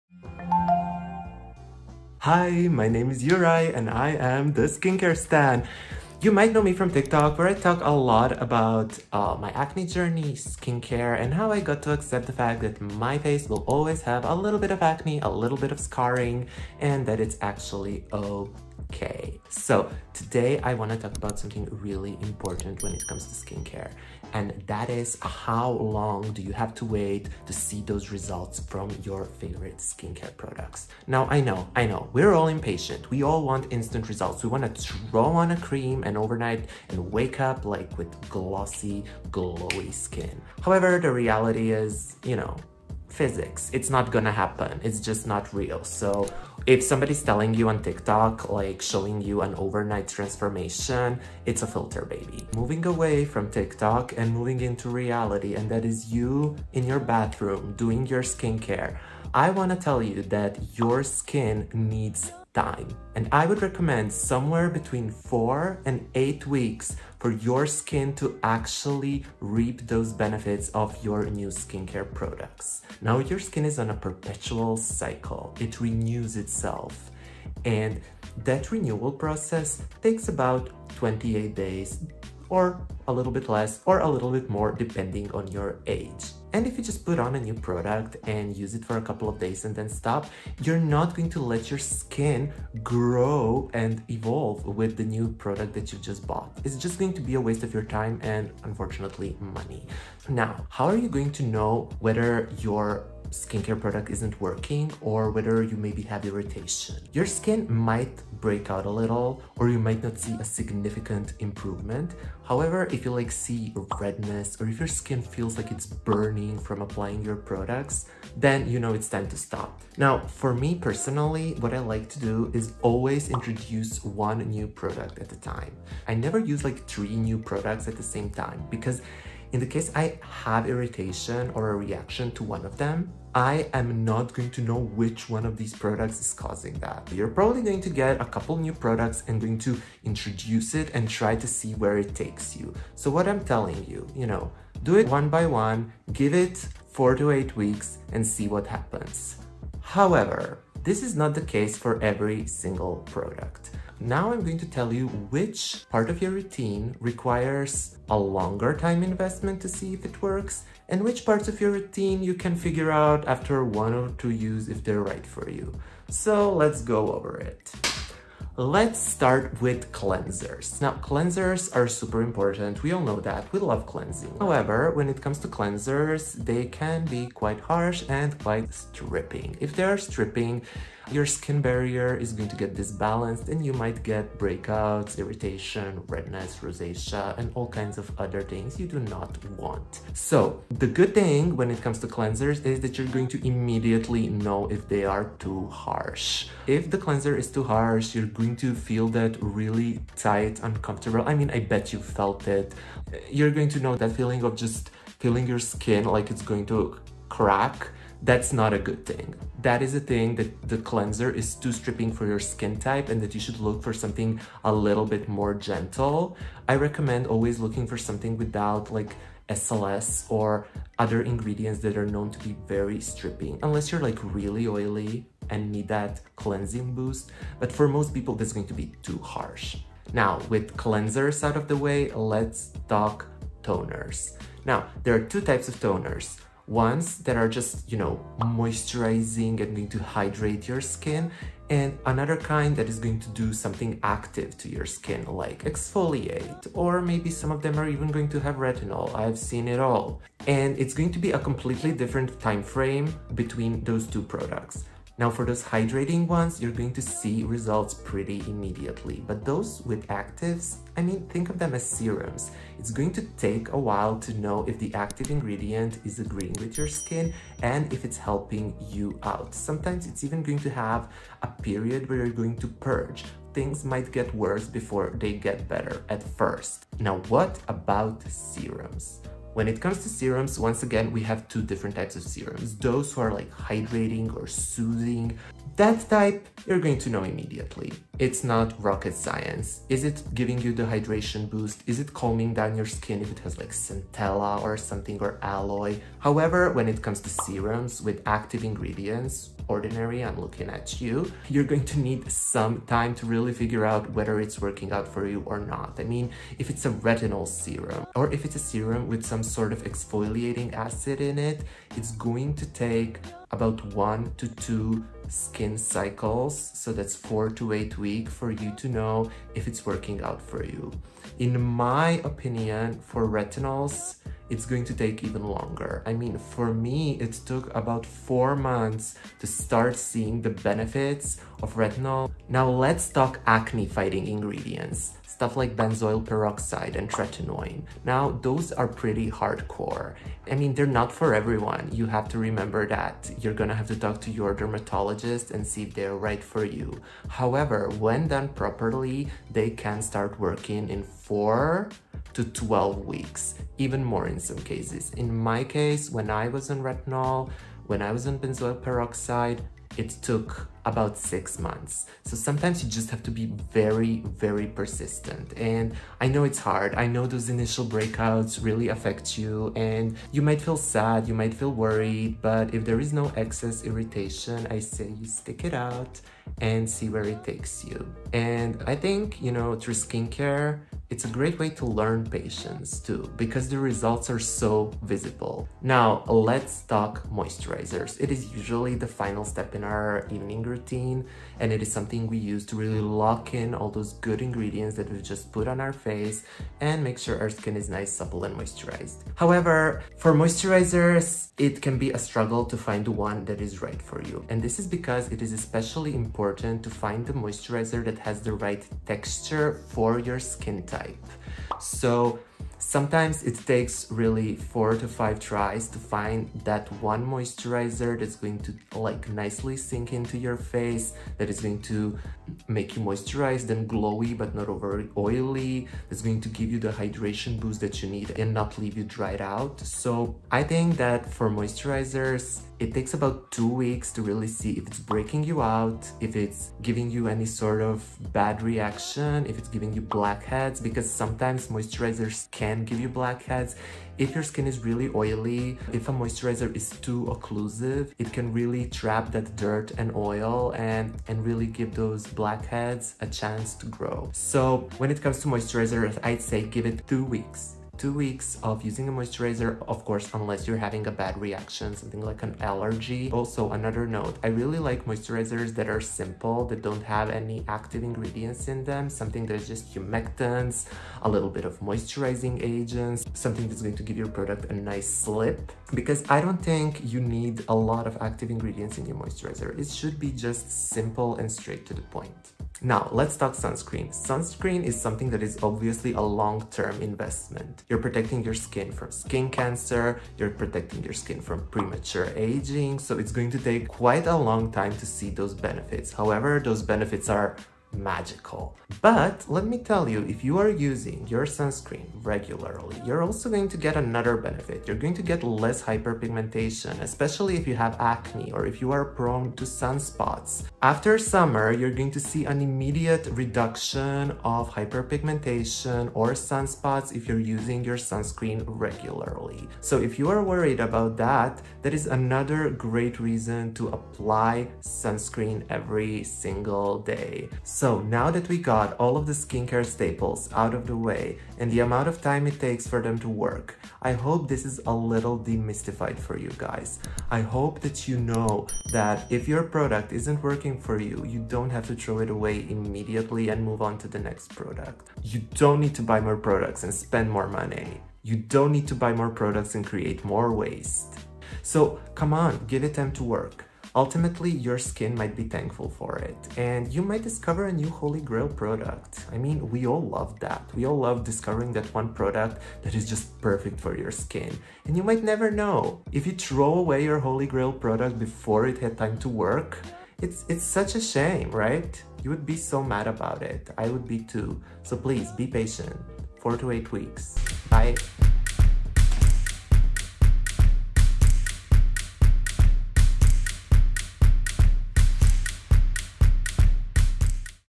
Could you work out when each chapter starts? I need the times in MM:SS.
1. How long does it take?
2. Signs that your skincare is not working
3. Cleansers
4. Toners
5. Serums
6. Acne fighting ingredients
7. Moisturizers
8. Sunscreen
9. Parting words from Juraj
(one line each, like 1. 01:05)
1. 00:53
2. 01:41
3. 02:50
4. 03:52
5. 04:35
6. 05:32
7. 06:27
8. 08:03
9. 08:46.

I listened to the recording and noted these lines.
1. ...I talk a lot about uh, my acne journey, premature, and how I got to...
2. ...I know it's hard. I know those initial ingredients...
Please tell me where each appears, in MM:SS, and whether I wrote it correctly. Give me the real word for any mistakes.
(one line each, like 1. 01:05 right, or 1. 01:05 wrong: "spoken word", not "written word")
1. 00:07 wrong: "skincare", not "premature"
2. 06:06 wrong: "breakouts", not "ingredients".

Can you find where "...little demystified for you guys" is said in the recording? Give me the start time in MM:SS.
08:54.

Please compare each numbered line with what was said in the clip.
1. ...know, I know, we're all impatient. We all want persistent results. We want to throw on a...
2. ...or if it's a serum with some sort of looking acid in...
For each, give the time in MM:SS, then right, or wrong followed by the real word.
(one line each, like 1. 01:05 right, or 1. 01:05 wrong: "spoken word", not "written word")
1. 00:31 wrong: "instant", not "persistent"
2. 05:08 wrong: "exfoliating", not "looking".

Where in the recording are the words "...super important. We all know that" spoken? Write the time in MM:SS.
02:51.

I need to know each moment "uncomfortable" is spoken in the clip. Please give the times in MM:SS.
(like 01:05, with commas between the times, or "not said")
03:20.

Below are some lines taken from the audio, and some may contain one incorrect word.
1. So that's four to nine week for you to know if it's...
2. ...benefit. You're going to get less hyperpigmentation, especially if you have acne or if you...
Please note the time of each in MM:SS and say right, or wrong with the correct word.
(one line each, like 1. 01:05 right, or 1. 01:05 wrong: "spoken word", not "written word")
1. 05:16 wrong: "eight", not "nine"
2. 08:24 right.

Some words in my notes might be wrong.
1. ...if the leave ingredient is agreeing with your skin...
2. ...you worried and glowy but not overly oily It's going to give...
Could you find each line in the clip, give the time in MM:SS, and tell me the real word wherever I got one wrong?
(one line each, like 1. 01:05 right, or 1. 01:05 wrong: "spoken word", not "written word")
1. 04:24 wrong: "active", not "leave"
2. 07:02 wrong: "moisturized", not "worried".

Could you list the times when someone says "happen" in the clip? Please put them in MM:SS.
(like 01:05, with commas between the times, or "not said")
00:44, 02:28.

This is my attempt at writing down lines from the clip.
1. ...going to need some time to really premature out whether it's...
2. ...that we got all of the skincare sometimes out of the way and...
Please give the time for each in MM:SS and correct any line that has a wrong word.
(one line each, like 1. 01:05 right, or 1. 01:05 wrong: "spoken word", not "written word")
1. 05:01 wrong: "figure", not "premature"
2. 08:48 wrong: "staples", not "sometimes".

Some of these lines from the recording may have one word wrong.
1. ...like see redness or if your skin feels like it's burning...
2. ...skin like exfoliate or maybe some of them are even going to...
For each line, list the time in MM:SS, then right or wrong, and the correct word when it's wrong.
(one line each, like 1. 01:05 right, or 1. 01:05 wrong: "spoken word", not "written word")
1. 01:53 right
2. 04:04 right.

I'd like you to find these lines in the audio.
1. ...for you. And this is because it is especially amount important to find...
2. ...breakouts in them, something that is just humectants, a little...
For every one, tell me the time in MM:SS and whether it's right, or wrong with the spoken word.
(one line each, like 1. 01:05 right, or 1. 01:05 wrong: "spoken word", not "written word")
1. 06:44 wrong: "important", not "amount"
2. 07:48 wrong: "ingredients", not "breakouts".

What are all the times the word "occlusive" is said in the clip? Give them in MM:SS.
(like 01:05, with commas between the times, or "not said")
07:27.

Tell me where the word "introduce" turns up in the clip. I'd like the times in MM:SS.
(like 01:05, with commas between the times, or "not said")
02:03, 02:20.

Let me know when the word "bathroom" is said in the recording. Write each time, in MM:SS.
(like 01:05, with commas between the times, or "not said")
00:56.